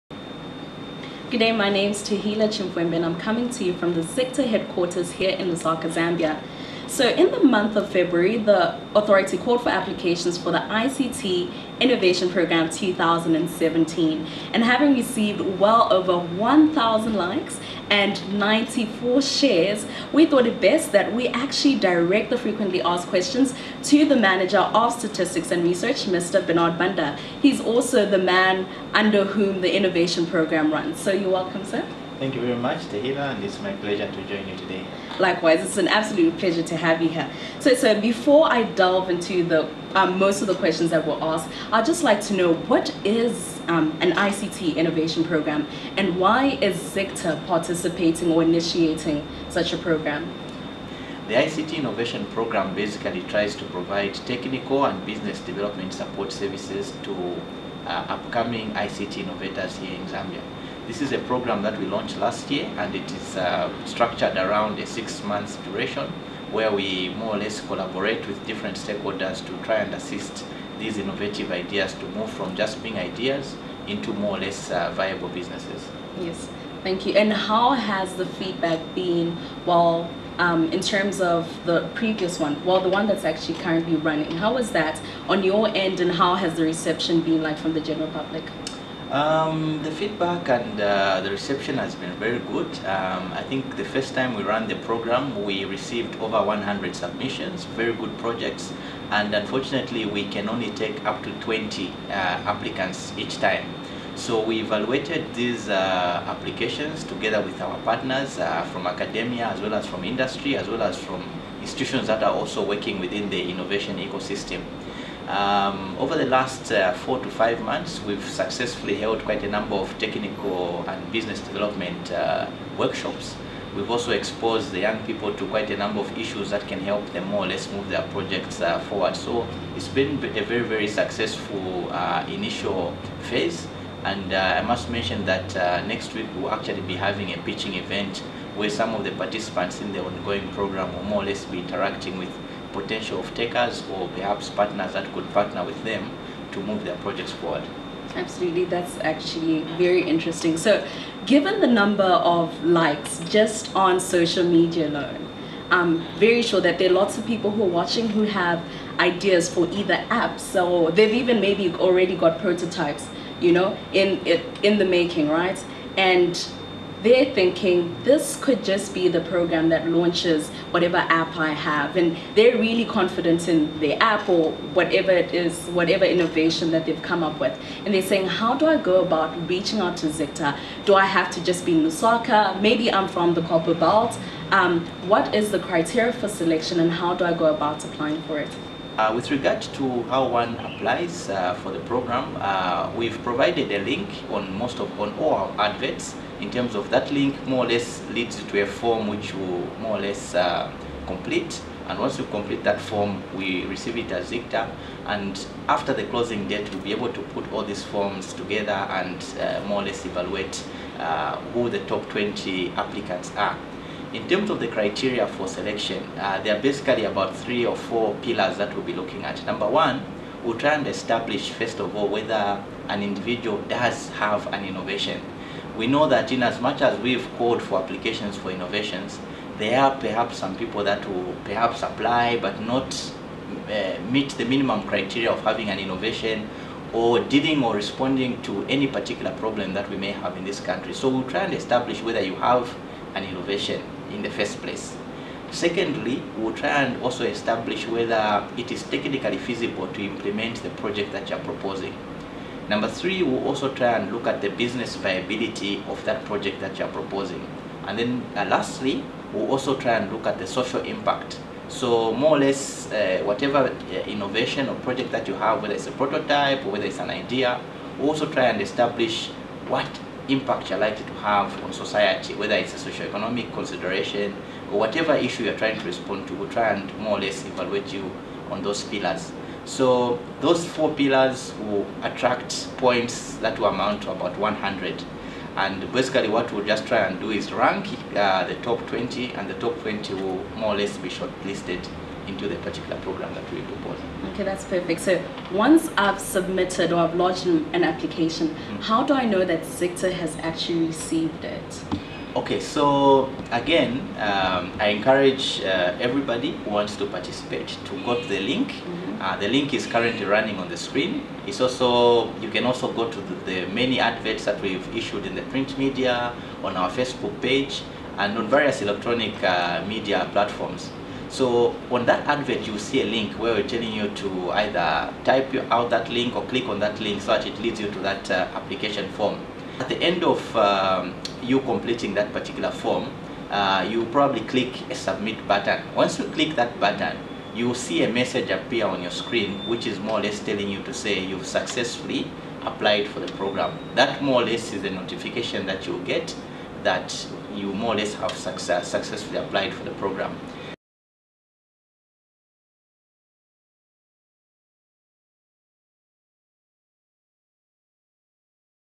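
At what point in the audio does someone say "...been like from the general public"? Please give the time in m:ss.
1:27.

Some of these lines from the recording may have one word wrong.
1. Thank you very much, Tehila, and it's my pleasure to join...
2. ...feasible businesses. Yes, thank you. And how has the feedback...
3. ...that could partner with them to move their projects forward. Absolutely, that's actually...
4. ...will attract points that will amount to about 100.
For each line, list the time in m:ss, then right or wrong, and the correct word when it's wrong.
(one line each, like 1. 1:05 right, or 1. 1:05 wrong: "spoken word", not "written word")
1. 0:32 right
2. 1:14 wrong: "viable", not "feasible"
3. 2:24 right
4. 4:41 right.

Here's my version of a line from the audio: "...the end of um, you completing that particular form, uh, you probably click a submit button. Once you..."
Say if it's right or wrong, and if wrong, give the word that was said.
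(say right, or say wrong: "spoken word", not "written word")
right.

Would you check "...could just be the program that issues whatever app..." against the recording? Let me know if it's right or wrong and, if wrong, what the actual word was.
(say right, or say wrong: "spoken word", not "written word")
wrong: "launches", not "issues".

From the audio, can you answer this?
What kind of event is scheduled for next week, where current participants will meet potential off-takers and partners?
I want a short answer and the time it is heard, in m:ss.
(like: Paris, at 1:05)
A pitching event, at 2:17.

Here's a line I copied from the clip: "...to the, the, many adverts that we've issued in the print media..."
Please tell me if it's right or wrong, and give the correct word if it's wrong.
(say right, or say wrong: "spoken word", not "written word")
right.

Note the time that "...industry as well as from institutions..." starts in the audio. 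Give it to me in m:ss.
1:50.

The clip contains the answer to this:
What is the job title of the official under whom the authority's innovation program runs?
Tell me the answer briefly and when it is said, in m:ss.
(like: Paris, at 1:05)
Manager of statistics and research, at 0:24.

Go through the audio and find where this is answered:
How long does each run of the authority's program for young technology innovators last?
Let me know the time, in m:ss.
1:04.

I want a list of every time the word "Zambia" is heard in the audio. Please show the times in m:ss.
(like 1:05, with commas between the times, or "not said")
0:05, 1:00.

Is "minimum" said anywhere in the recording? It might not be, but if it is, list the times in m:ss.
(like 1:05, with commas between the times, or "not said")
3:54.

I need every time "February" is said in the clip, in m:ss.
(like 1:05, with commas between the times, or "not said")
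0:07.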